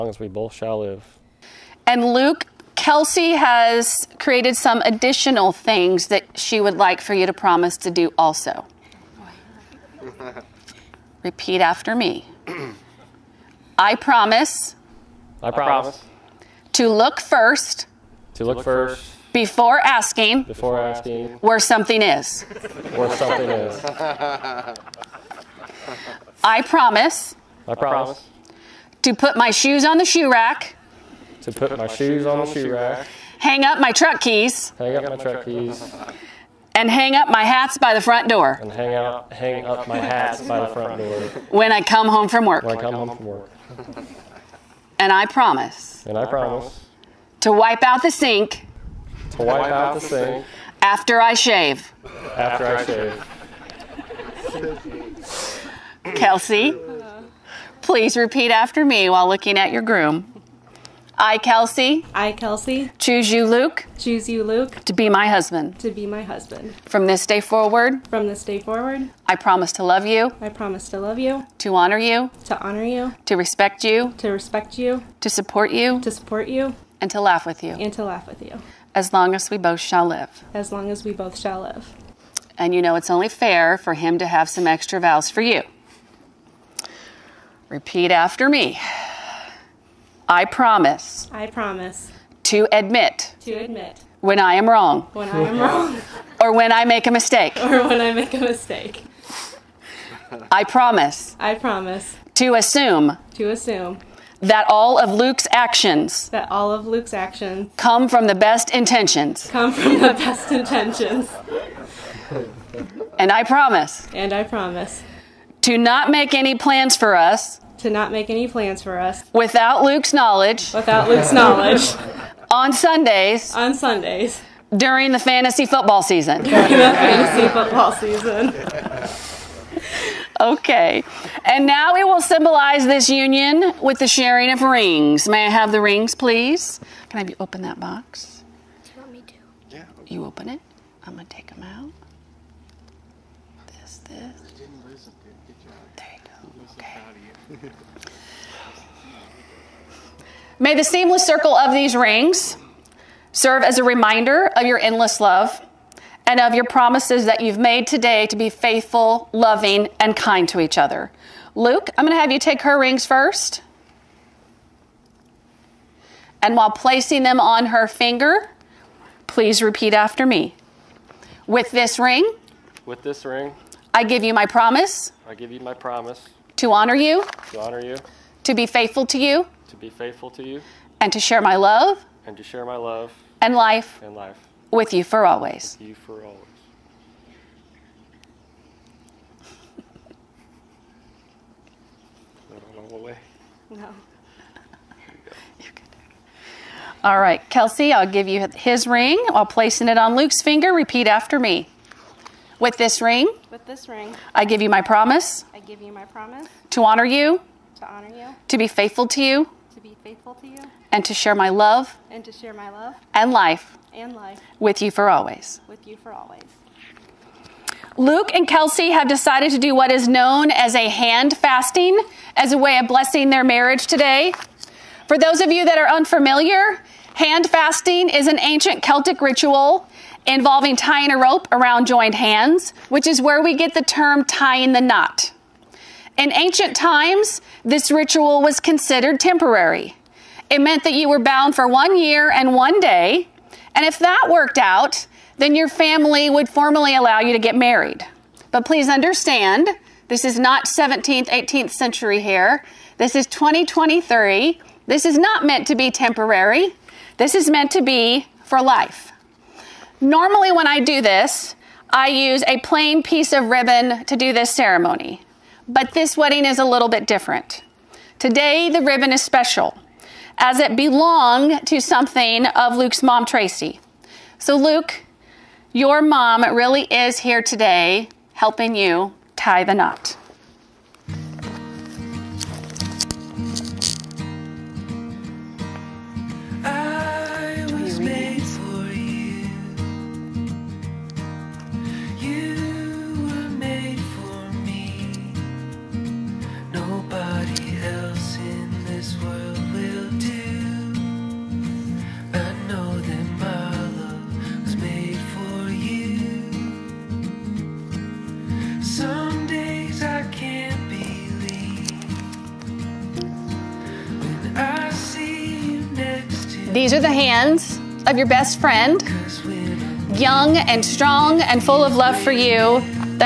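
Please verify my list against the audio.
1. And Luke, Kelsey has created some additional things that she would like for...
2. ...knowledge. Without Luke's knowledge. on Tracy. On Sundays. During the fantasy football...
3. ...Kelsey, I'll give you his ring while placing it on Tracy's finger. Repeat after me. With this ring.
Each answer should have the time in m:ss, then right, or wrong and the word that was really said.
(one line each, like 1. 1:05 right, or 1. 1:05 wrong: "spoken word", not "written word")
1. 0:01 right
2. 2:00 wrong: "Sundays", not "Tracy"
3. 3:17 wrong: "Luke", not "Tracy".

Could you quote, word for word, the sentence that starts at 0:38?
and hang hang up my hats by the front door when I come home from work.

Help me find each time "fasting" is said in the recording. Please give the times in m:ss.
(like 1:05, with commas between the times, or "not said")
3:41, 3:47.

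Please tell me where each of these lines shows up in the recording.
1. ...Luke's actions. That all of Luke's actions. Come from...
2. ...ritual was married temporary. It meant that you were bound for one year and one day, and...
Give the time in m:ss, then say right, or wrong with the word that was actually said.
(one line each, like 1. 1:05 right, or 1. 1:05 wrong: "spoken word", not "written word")
1. 1:45 right
2. 3:57 wrong: "considered", not "married".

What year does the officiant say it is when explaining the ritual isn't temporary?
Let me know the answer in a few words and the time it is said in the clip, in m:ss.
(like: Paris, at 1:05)
2023, at 4:12.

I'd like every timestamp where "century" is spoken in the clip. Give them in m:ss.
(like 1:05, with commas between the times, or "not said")
4:11.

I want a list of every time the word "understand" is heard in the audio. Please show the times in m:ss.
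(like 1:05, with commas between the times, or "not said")
4:08.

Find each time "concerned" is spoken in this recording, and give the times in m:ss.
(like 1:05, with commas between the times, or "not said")
not said.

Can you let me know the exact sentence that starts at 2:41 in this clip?
Luke, I'm going to have you take her rings first.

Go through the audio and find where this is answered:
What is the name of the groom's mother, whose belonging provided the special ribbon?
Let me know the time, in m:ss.
4:33.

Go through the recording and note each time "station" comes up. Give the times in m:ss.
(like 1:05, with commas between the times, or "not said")
not said.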